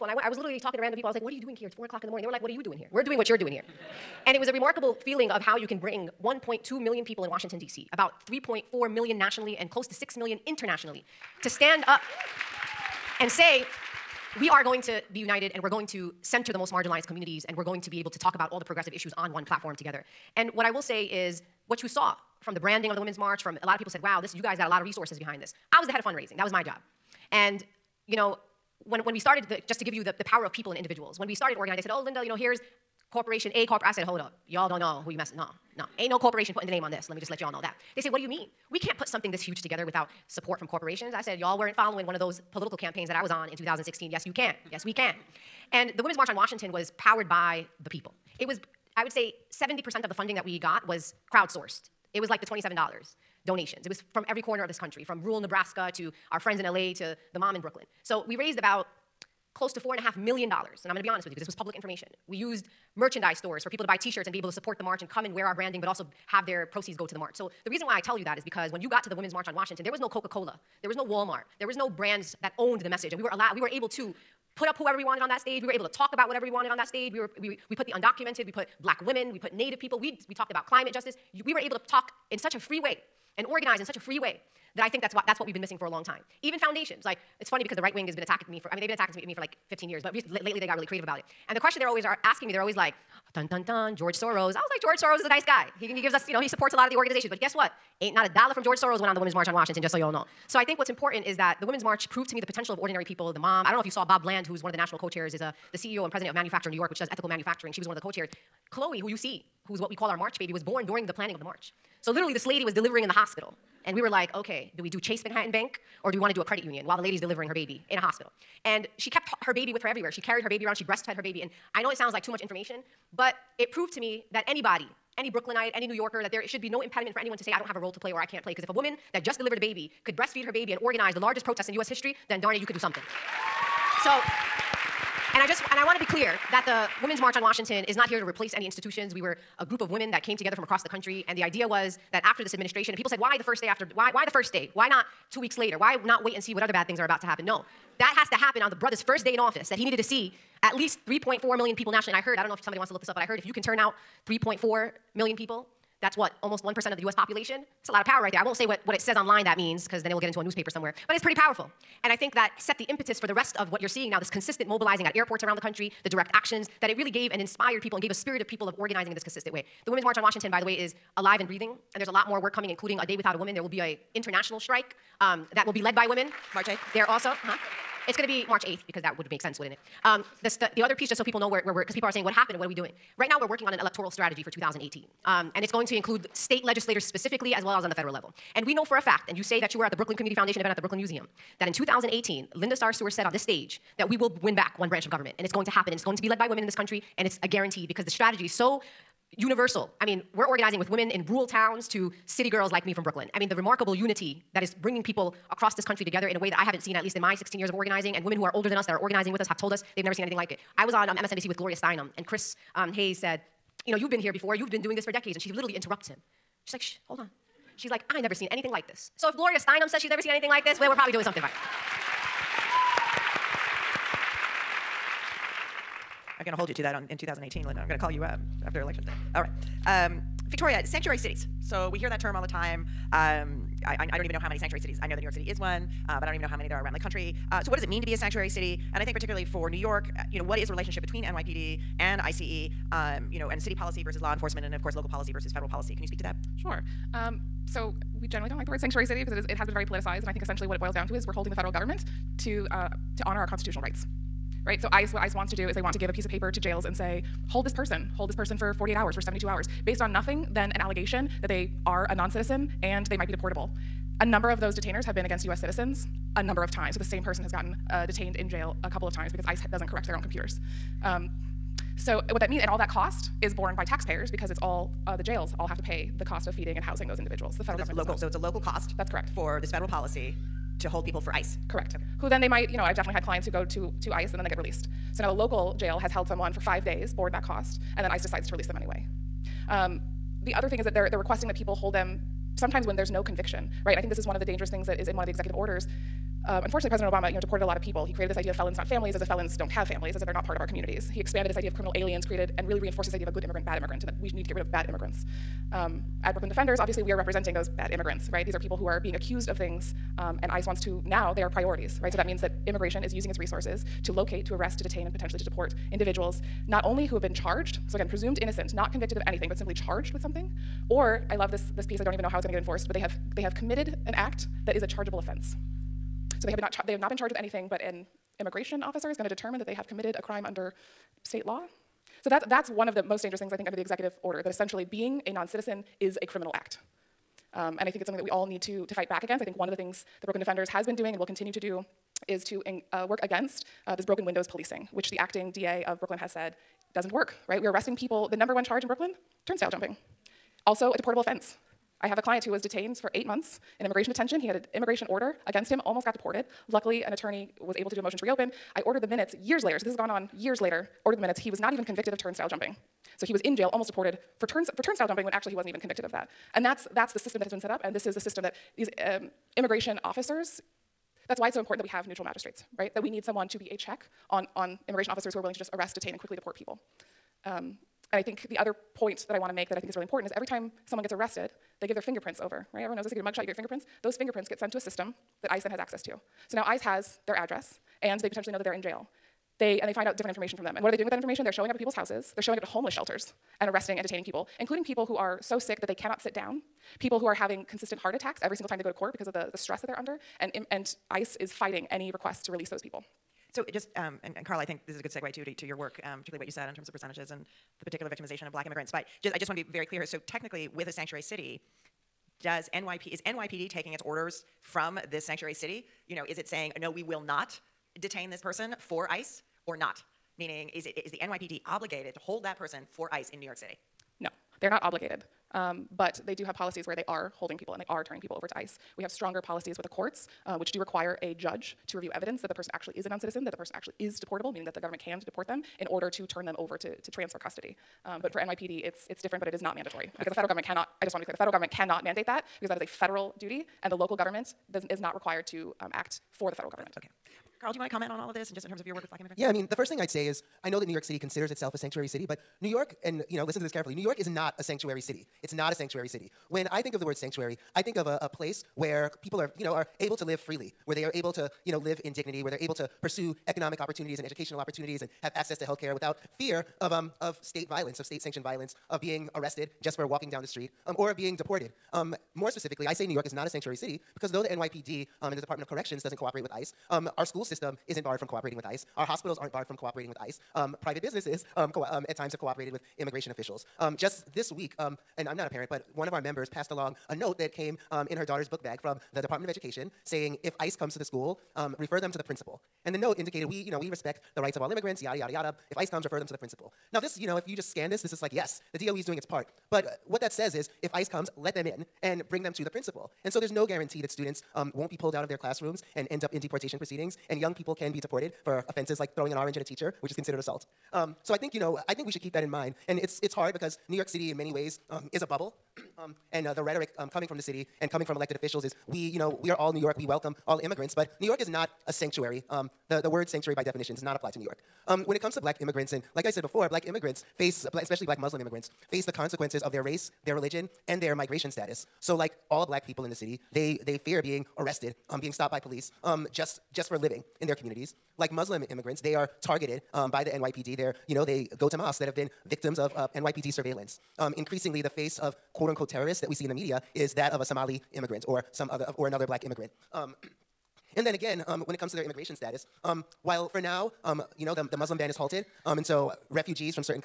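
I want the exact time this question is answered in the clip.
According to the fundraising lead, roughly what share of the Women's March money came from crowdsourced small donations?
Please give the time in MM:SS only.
00:49.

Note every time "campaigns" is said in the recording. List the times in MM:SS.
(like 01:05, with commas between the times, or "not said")
00:42.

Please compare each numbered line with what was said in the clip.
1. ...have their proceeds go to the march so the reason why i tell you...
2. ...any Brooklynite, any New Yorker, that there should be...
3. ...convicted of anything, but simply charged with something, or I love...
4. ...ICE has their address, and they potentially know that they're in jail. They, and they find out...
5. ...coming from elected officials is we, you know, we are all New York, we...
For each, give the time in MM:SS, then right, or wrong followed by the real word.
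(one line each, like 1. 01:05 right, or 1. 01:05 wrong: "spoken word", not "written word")
1. 01:06 right
2. 02:05 right
3. 05:18 right
4. 06:26 right
5. 08:37 right.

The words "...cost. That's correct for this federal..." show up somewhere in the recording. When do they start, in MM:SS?
04:38.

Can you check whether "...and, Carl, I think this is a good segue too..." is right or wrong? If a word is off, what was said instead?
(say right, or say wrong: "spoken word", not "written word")
right.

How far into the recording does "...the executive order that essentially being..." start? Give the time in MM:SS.
05:33.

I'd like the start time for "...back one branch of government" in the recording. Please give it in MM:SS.
03:14.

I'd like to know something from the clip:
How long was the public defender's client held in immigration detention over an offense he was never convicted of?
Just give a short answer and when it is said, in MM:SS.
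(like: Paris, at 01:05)
Eight months, at 05:53.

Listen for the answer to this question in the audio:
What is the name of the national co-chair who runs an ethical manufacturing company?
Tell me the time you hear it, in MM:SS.
01:44.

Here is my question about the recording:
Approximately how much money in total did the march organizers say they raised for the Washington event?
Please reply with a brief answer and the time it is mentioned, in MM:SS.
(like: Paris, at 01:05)
about 4.5 million dollars, at 00:59.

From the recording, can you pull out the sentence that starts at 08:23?
And so there's no guarantee that students um, won't be pulled out of their classrooms and end up in deportation proceedings.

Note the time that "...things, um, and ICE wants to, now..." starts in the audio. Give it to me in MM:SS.
05:09.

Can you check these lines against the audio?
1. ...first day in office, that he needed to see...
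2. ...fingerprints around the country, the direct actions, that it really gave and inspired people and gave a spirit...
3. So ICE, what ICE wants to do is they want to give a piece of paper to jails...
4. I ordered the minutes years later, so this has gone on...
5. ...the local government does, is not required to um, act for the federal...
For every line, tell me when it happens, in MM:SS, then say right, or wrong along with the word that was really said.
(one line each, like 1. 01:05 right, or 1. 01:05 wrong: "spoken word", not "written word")
1. 02:28 right
2. 02:45 wrong: "airports", not "fingerprints"
3. 04:14 right
4. 05:58 right
5. 07:23 right.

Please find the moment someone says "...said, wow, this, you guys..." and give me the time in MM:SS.
00:23.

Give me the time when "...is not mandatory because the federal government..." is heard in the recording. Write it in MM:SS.
07:19.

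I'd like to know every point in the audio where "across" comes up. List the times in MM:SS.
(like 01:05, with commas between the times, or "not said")
02:20, 03:25.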